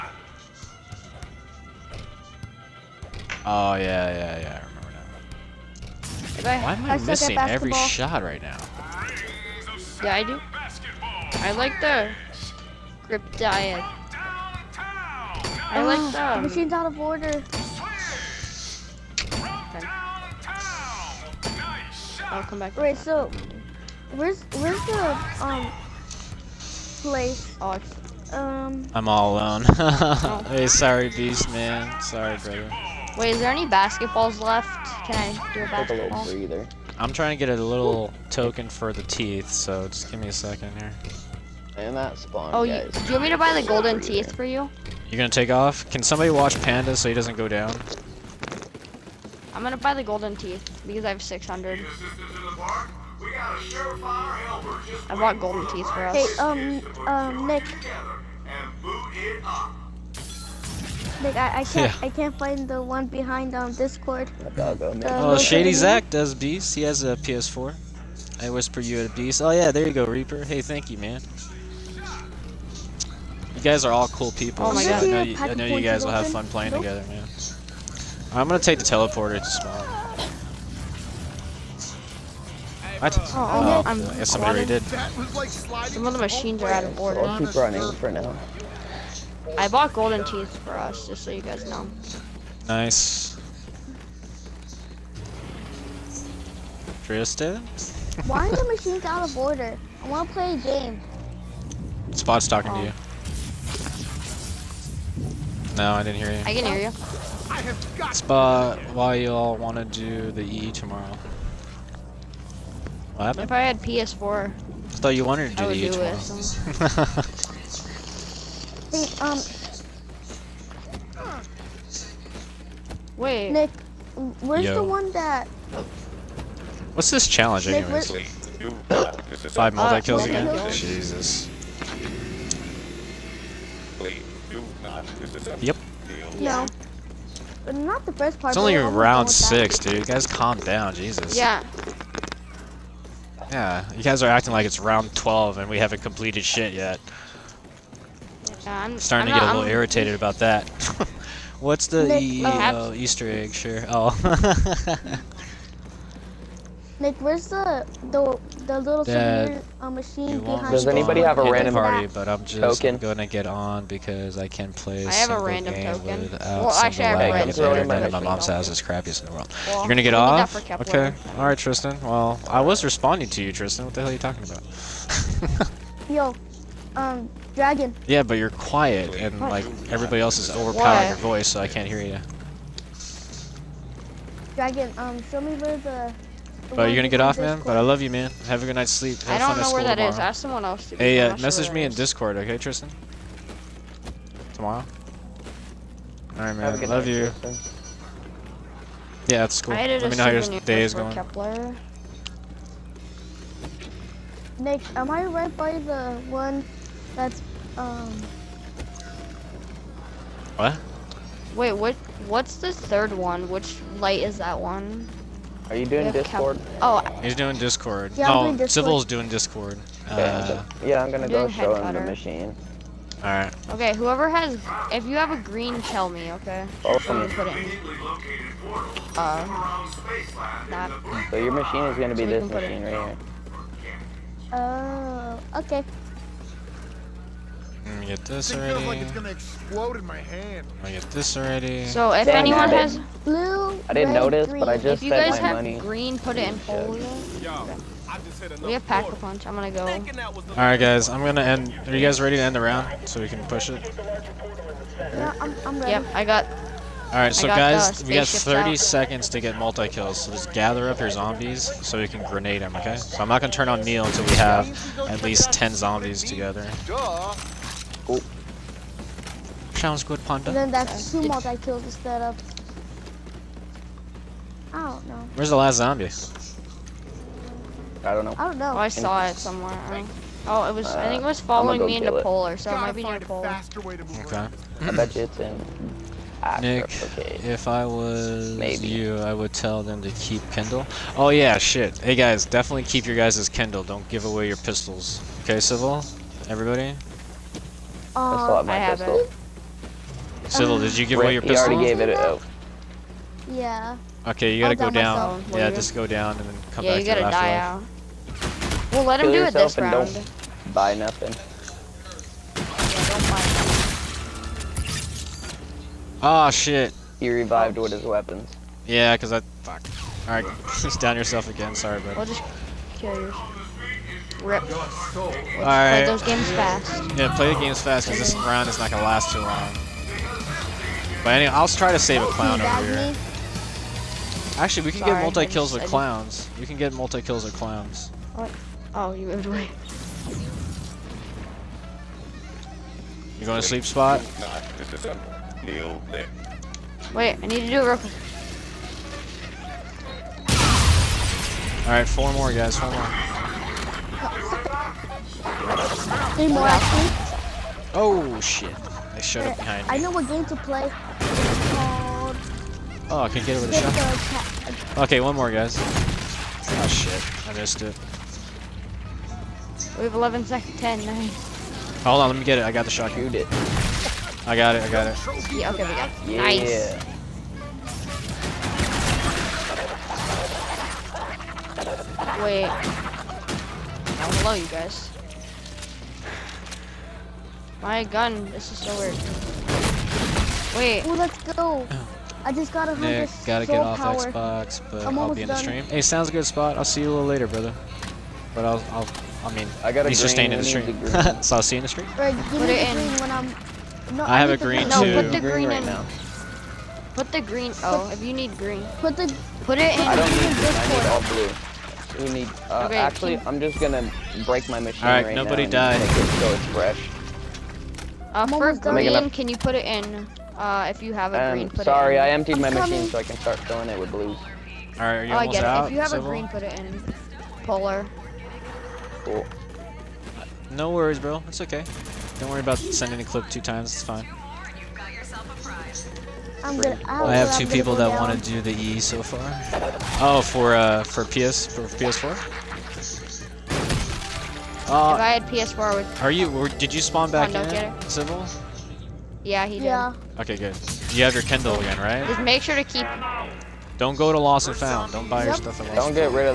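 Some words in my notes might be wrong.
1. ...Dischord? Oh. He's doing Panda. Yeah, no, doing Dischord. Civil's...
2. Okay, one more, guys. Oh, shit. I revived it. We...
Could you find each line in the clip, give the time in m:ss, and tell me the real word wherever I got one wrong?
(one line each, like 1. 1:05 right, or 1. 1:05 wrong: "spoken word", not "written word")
1. 3:36 wrong: "Dischord", not "Panda"
2. 6:04 wrong: "missed", not "revived".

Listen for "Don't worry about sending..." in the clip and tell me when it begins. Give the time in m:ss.
7:12.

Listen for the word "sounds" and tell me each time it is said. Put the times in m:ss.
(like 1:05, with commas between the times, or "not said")
4:29, 6:36.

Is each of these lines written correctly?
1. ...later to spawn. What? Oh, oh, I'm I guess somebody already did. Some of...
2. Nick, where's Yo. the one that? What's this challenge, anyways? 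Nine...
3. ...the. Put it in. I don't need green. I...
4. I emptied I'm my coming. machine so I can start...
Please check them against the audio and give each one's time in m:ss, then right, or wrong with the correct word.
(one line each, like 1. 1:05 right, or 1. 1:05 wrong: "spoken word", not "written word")
1. 1:18 wrong: "teleporter", not "later"
2. 2:03 wrong: "Five", not "Nine"
3. 6:49 right
4. 7:02 right.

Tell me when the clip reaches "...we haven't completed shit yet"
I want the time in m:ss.
2:25.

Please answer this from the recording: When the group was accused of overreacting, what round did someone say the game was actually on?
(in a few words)
Round 6.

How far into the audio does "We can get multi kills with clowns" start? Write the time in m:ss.
5:36.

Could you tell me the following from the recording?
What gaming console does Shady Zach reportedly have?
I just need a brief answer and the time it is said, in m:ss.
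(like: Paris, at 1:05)
PS4, at 1:06.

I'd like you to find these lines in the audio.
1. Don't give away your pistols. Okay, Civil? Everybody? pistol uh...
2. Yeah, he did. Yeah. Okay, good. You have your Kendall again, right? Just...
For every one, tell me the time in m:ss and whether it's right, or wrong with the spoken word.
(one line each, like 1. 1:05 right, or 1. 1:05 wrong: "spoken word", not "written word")
1. 4:53 right
2. 7:29 right.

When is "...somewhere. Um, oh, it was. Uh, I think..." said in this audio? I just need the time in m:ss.
4:39.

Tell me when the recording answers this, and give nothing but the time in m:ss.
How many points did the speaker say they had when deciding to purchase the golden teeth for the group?
0:51.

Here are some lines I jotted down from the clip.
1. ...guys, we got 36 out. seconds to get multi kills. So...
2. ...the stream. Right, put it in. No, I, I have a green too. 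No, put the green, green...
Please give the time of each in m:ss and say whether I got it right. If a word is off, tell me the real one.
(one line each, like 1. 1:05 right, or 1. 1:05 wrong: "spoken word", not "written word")
1. 4:17 wrong: "30", not "36"
2. 6:41 right.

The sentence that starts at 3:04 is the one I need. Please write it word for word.
Dragon, um, show me where the but you're gonna get off, man.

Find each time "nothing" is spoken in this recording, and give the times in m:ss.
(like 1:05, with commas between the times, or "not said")
5:10.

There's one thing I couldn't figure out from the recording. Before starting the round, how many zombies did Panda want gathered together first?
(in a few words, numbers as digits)
10.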